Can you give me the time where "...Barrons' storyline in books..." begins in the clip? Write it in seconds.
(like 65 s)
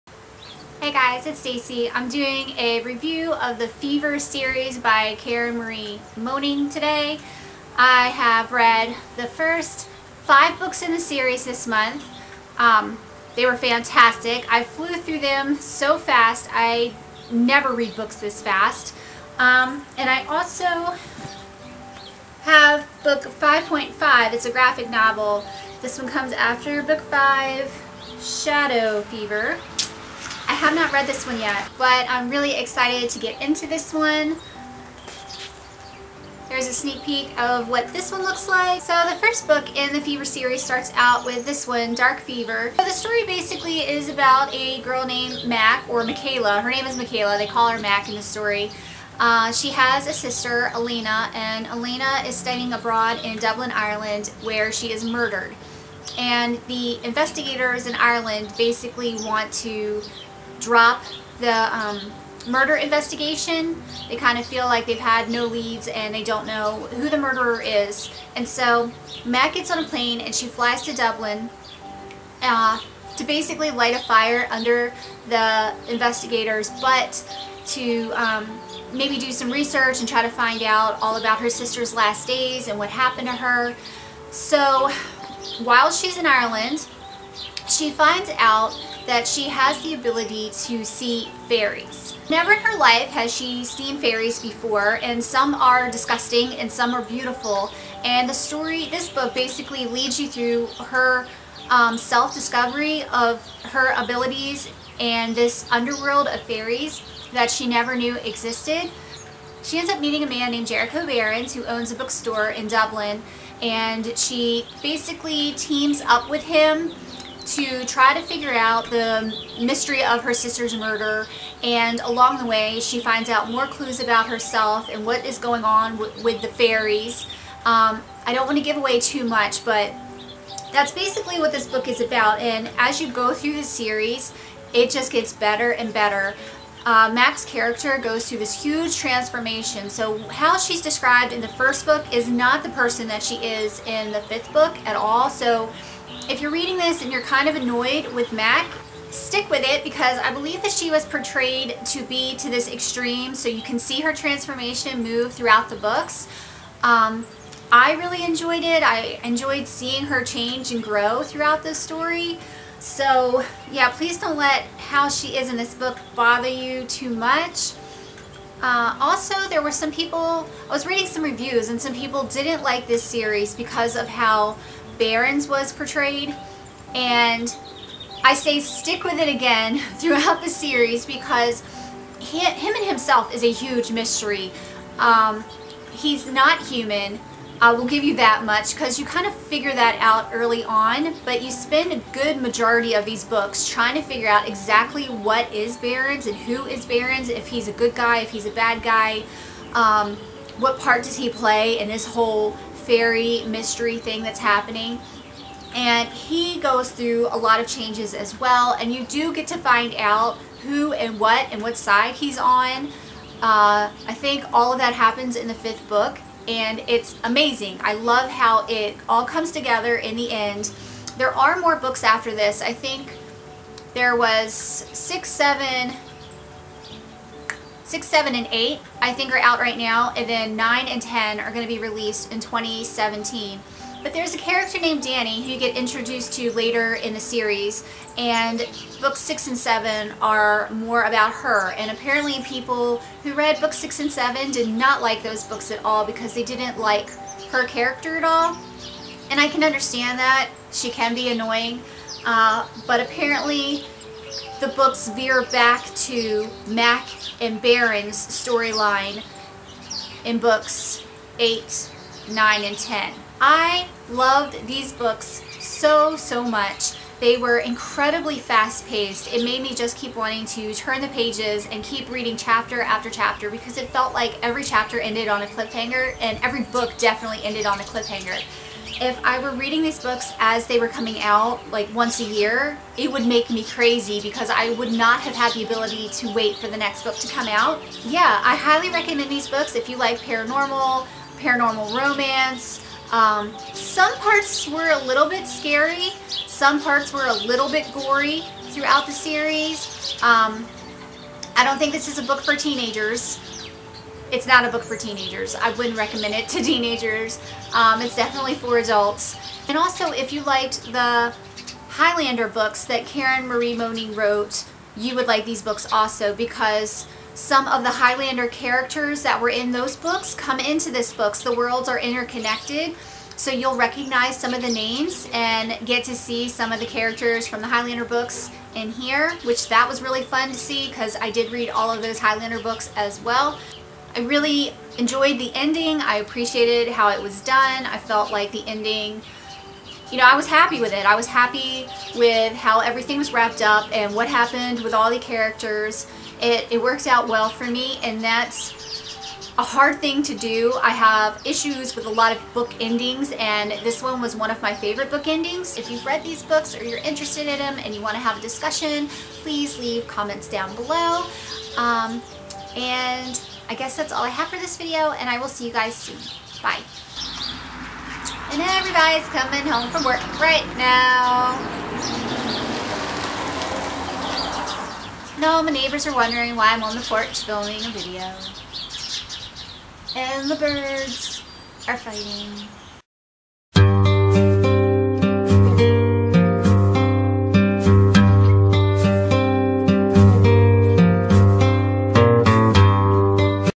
257 s.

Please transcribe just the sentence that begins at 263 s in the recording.
I loved these books so, so much.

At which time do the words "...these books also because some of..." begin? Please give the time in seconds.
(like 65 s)
315 s.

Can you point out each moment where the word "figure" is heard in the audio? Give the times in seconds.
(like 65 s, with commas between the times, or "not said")
118 s, 189 s, 194 s.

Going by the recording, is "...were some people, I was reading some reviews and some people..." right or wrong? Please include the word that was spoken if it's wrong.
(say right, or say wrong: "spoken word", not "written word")
right.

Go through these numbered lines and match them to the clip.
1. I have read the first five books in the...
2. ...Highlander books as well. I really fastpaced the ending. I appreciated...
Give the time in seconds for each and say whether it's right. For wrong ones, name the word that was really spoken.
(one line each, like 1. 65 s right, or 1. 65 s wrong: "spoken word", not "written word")
1. 7 s right
2. 332 s wrong: "enjoyed", not "fastpaced".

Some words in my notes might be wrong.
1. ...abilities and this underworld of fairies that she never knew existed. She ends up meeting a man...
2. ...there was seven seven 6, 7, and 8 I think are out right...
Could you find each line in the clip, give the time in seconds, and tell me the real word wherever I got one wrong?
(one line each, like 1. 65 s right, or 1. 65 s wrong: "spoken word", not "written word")
1. 103 s right
2. 223 s wrong: "six", not "seven".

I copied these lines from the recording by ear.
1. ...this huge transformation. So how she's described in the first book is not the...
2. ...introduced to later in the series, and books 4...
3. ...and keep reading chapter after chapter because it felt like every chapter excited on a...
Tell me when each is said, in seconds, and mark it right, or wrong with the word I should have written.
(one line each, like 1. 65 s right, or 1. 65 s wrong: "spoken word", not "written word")
1. 138 s right
2. 235 s wrong: "6", not "4"
3. 271 s wrong: "ended", not "excited".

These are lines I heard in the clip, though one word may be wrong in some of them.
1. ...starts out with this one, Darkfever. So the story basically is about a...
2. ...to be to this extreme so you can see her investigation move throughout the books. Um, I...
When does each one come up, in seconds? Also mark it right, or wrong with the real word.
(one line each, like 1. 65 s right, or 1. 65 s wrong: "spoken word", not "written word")
1. 40 s right
2. 151 s wrong: "transformation", not "investigation".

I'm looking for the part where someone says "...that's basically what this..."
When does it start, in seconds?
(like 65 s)
130 s.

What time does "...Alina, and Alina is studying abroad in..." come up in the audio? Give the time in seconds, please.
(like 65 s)
50 s.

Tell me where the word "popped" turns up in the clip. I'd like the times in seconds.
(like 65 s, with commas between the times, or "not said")
not said.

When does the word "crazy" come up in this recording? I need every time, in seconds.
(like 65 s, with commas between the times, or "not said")
283 s.